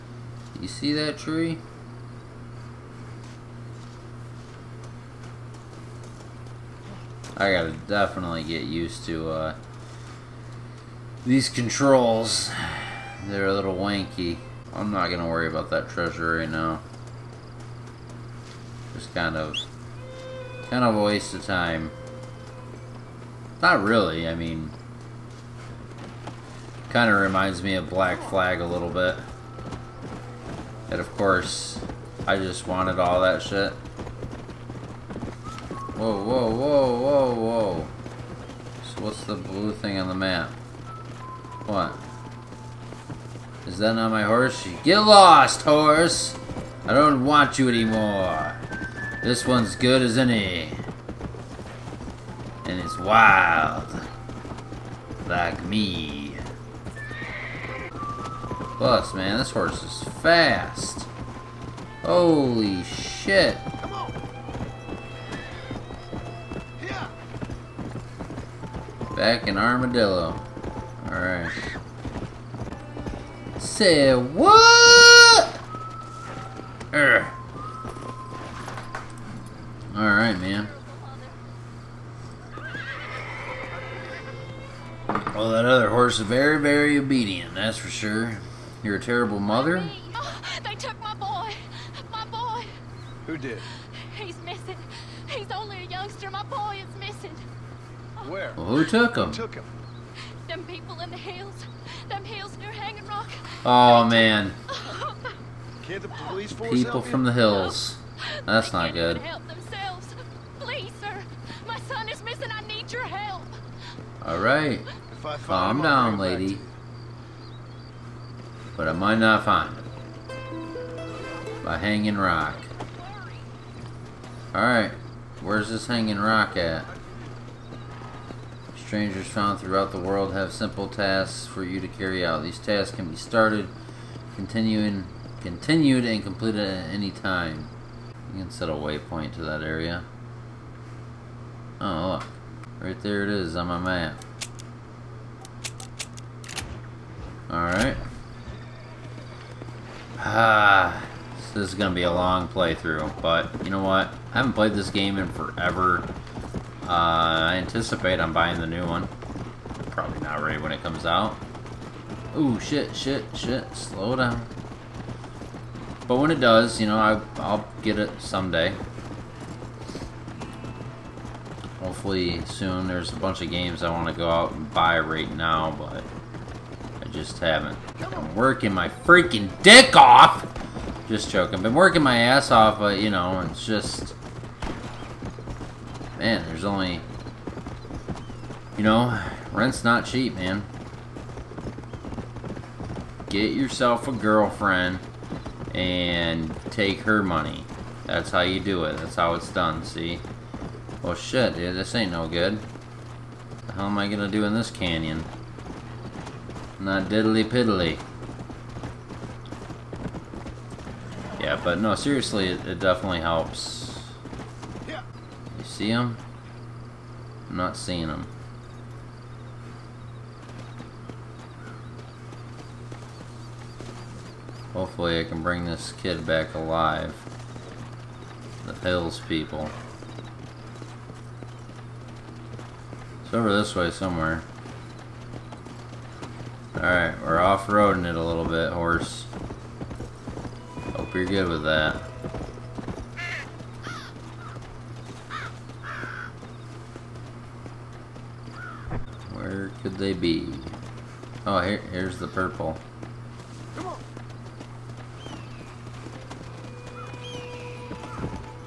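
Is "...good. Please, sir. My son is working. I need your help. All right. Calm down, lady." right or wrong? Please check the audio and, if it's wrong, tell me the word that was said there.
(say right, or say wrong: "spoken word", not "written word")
wrong: "missing", not "working".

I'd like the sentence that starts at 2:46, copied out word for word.
But when it does, you know, I, I'll get it someday.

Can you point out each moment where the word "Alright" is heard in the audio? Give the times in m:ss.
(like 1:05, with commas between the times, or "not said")
1:11, 1:19, 2:04, 2:27, 3:56.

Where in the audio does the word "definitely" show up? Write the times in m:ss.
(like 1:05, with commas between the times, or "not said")
0:07, 3:32.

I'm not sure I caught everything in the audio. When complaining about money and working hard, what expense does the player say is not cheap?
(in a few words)
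rent.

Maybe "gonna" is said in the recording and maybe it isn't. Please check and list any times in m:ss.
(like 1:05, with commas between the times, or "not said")
0:15, 3:24.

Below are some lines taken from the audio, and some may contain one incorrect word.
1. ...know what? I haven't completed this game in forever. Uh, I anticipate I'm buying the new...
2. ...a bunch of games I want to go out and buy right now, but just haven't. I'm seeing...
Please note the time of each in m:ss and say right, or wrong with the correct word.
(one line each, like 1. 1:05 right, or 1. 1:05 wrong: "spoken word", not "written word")
1. 2:33 wrong: "played", not "completed"
2. 2:53 wrong: "working", not "seeing".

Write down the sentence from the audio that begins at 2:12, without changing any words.
These tasks can be started, continuing, continued, and completed at any time.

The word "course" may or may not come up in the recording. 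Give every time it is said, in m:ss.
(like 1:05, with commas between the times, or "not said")
0:31.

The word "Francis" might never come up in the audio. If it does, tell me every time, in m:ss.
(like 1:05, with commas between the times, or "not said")
not said.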